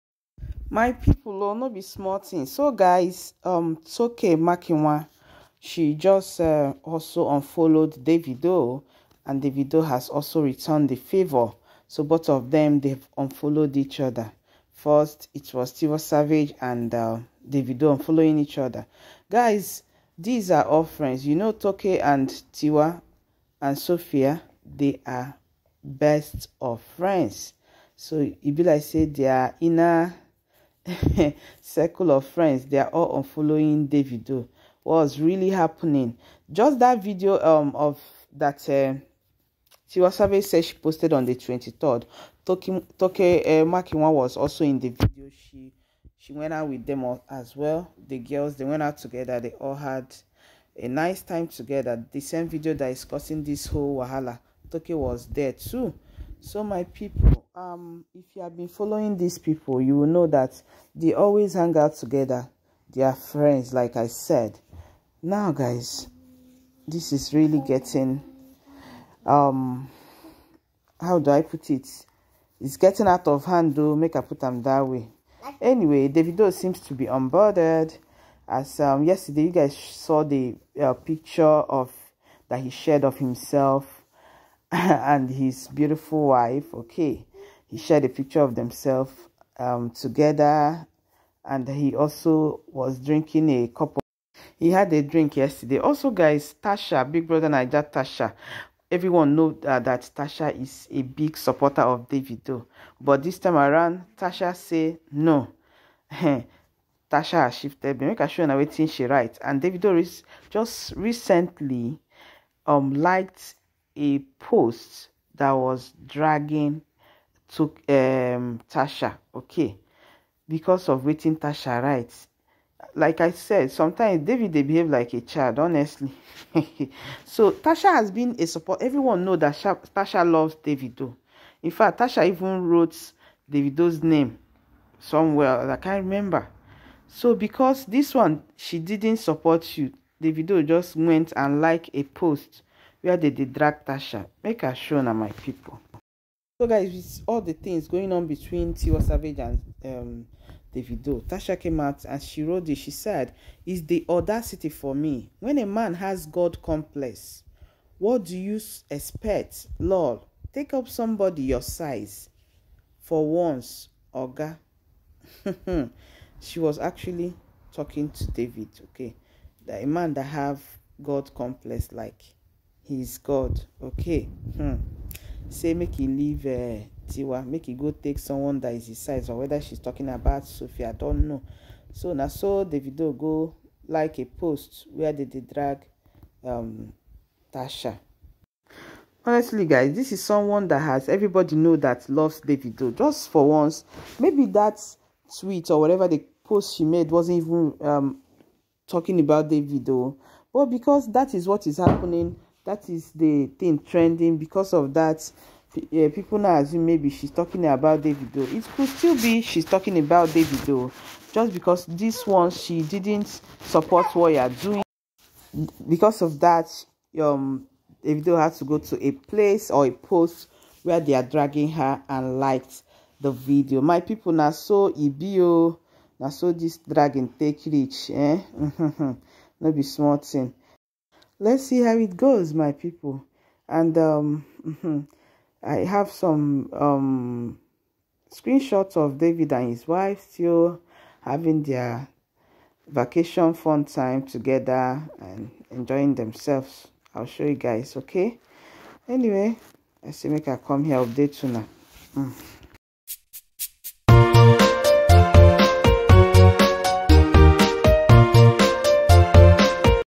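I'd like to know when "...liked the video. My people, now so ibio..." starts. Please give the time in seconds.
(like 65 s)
222 s.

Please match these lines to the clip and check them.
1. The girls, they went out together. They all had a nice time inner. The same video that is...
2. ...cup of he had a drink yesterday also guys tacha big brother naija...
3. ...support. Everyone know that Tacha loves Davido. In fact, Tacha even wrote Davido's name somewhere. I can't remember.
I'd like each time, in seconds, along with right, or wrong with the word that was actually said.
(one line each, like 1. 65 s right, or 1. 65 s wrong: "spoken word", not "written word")
1. 48 s wrong: "together", not "inner"
2. 93 s right
3. 128 s right.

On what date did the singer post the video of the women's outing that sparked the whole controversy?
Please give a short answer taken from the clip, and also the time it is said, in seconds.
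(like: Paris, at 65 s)
23rd, at 41 s.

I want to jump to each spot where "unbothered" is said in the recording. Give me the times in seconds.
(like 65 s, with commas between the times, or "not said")
77 s.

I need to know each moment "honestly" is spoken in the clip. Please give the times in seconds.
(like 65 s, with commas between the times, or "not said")
125 s, 189 s.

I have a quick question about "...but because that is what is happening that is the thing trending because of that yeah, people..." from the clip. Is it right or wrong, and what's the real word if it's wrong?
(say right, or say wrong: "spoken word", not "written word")
right.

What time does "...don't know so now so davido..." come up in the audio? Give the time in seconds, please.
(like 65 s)
180 s.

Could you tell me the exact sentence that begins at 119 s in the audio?
Okay, because of waiting Tacha writes.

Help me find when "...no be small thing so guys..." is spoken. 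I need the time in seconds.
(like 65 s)
1 s.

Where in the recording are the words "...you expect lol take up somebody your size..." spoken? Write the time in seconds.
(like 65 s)
158 s.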